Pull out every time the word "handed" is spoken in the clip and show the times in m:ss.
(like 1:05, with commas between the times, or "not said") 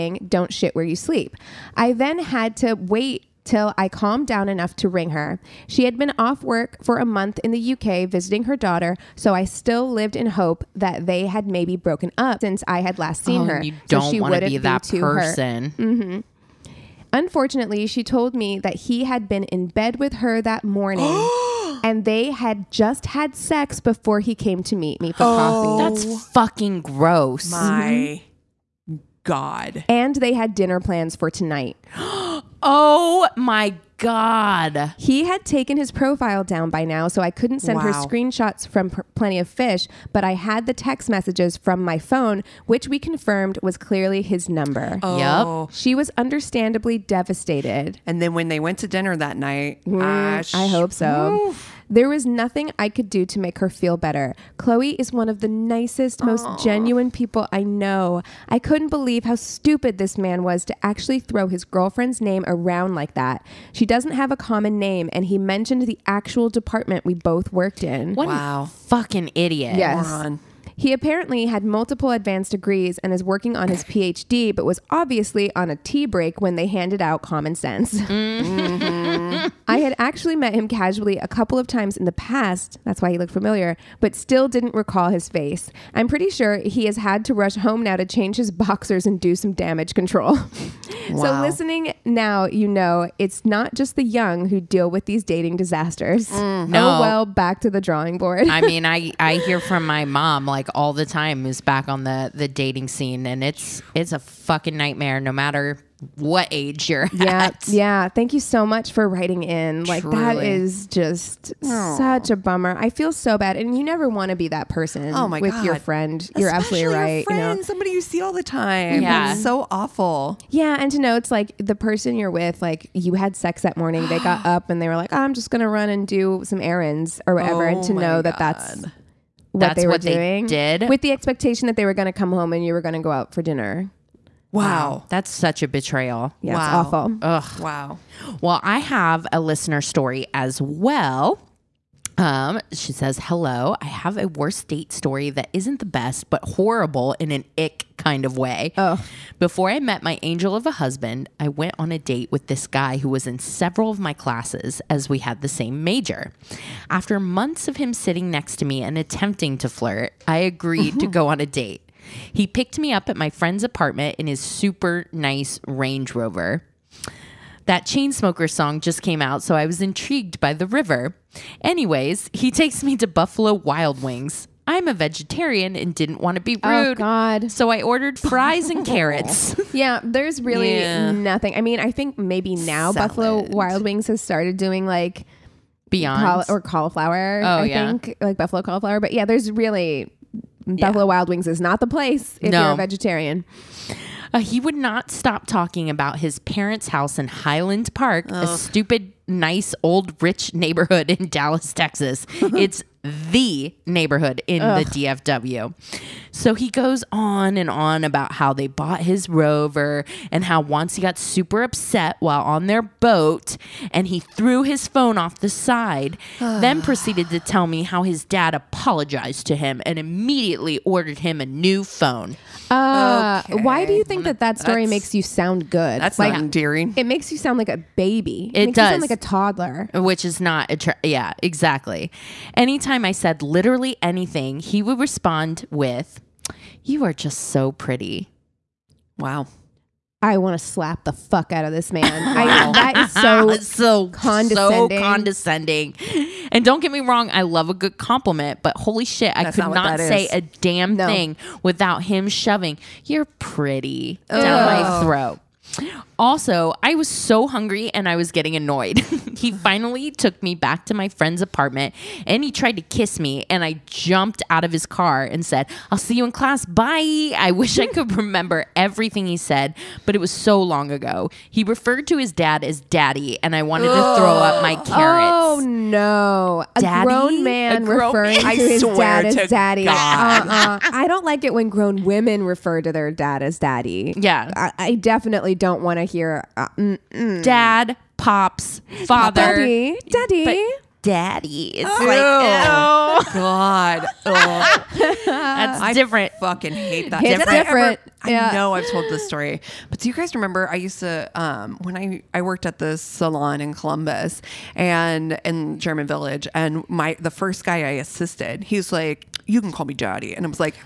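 1:16.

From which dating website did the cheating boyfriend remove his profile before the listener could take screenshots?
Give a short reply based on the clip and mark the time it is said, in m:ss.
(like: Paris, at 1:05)
Plenty of Fish, at 0:39.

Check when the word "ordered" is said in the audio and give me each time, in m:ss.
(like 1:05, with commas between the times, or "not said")
2:57, 3:40.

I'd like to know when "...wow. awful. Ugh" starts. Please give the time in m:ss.
2:16.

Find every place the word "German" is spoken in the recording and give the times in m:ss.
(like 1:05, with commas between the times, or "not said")
5:05.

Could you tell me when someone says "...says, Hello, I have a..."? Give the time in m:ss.
2:22.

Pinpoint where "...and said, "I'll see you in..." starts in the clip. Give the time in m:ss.
4:25.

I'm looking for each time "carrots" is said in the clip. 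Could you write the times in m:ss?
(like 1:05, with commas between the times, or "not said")
2:58, 4:34.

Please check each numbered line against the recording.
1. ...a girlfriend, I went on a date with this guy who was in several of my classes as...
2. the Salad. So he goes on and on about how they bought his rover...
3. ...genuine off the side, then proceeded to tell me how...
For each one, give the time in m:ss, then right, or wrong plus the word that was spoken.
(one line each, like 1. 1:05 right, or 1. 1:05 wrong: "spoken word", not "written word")
1. 2:30 wrong: "husband", not "girlfriend"
2. 3:24 wrong: "DFW", not "Salad"
3. 3:34 wrong: "phone", not "genuine".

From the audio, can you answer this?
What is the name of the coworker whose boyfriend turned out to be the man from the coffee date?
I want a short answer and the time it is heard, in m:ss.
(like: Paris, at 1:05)
Chloe, at 0:54.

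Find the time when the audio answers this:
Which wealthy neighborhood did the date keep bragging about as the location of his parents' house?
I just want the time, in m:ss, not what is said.
3:17.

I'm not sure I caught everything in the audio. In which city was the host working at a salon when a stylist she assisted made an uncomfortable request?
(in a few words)
Columbus.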